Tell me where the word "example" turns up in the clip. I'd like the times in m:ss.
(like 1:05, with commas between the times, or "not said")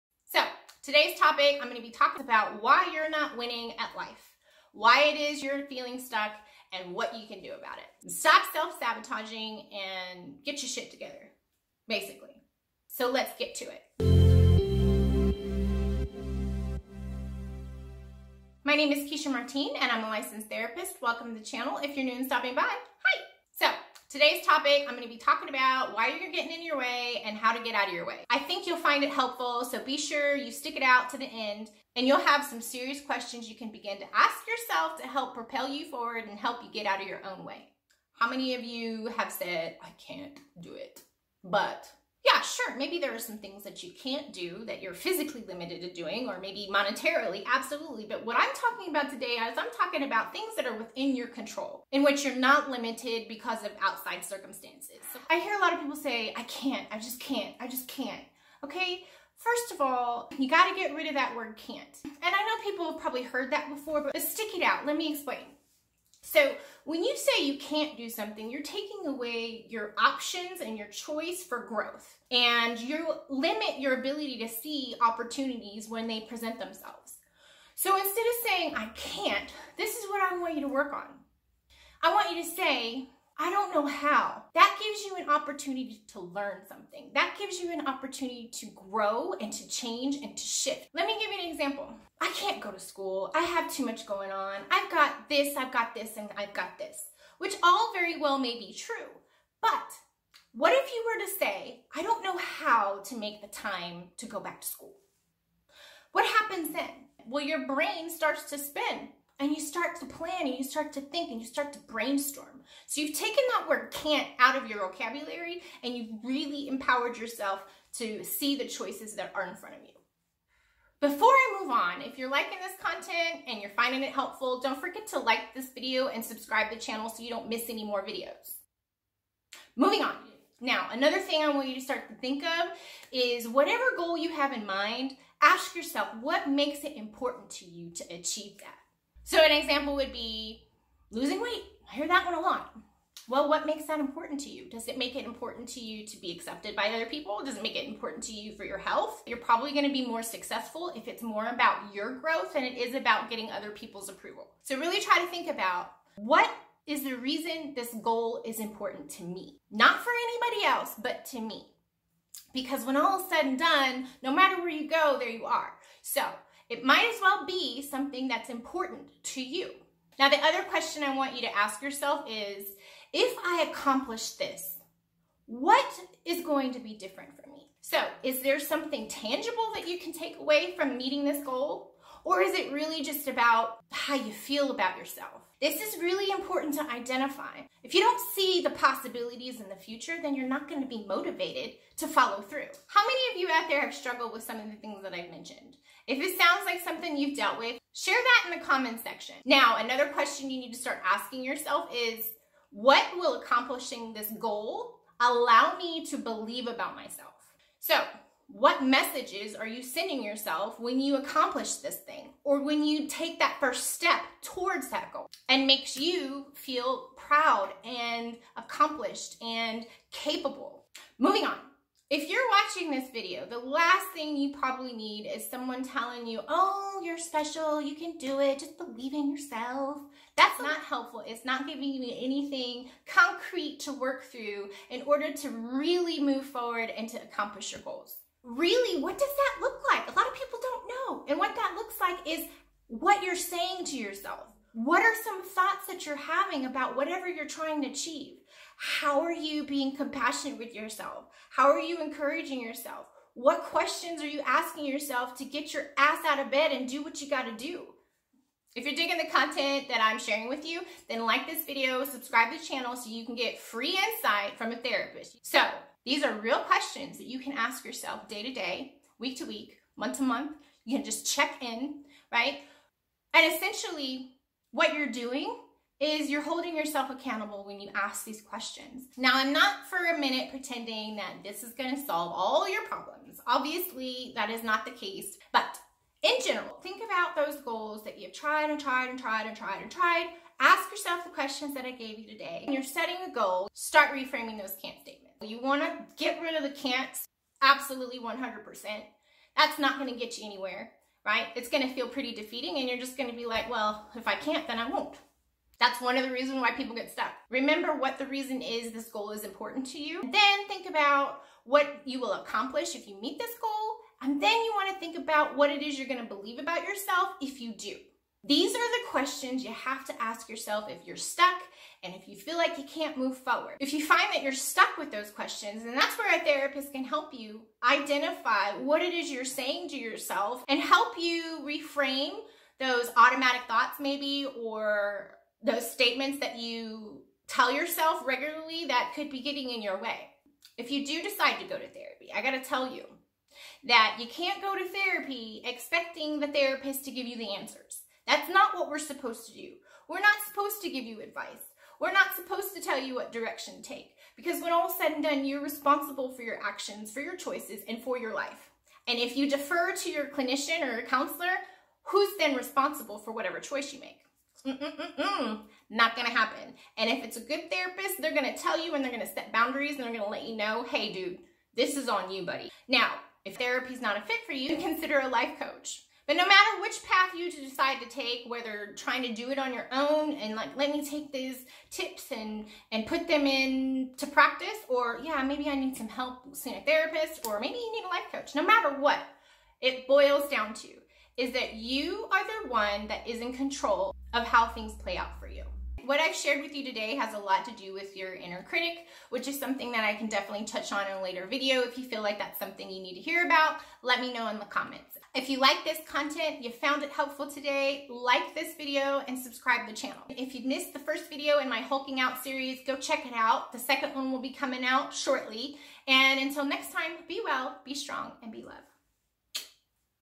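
1:31, 2:19.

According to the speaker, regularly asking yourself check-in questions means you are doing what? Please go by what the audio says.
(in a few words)
Holding yourself accountable.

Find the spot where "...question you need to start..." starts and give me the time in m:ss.
3:20.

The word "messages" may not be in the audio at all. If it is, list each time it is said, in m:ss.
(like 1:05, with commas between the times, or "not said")
3:28.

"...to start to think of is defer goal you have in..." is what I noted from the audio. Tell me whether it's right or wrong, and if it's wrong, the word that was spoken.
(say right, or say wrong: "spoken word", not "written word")
wrong: "whatever", not "defer".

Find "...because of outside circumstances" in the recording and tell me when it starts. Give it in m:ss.
0:53.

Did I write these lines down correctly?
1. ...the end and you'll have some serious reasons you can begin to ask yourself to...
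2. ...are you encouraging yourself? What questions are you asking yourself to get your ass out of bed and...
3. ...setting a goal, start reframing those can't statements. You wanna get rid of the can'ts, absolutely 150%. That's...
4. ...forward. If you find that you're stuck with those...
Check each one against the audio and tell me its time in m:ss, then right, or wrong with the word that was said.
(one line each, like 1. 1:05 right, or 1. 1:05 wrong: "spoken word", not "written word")
1. 0:31 wrong: "questions", not "reasons"
2. 4:11 right
3. 4:52 wrong: "100", not "150"
4. 5:23 right.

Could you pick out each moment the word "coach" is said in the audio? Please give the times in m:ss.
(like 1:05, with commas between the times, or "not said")
6:15, 6:28.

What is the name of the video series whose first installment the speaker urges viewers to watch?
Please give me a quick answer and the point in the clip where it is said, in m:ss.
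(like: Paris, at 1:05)
Hulking out, at 6:51.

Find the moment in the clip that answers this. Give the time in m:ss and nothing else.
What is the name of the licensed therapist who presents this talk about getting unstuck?
0:19.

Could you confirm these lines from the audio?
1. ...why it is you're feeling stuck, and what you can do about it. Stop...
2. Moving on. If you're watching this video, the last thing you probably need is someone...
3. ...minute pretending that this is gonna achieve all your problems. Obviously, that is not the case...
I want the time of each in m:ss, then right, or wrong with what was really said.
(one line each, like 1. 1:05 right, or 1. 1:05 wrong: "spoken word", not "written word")
1. 0:04 right
2. 3:41 right
3. 4:40 wrong: "solve", not "achieve".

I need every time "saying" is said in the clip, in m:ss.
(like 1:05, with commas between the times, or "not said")
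1:18, 4:03, 5:29.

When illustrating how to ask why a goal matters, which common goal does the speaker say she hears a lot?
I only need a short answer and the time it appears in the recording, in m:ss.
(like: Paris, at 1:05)
Losing weight, at 2:21.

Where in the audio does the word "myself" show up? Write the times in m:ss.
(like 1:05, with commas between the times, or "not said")
3:26.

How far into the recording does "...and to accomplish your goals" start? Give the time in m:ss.
3:56.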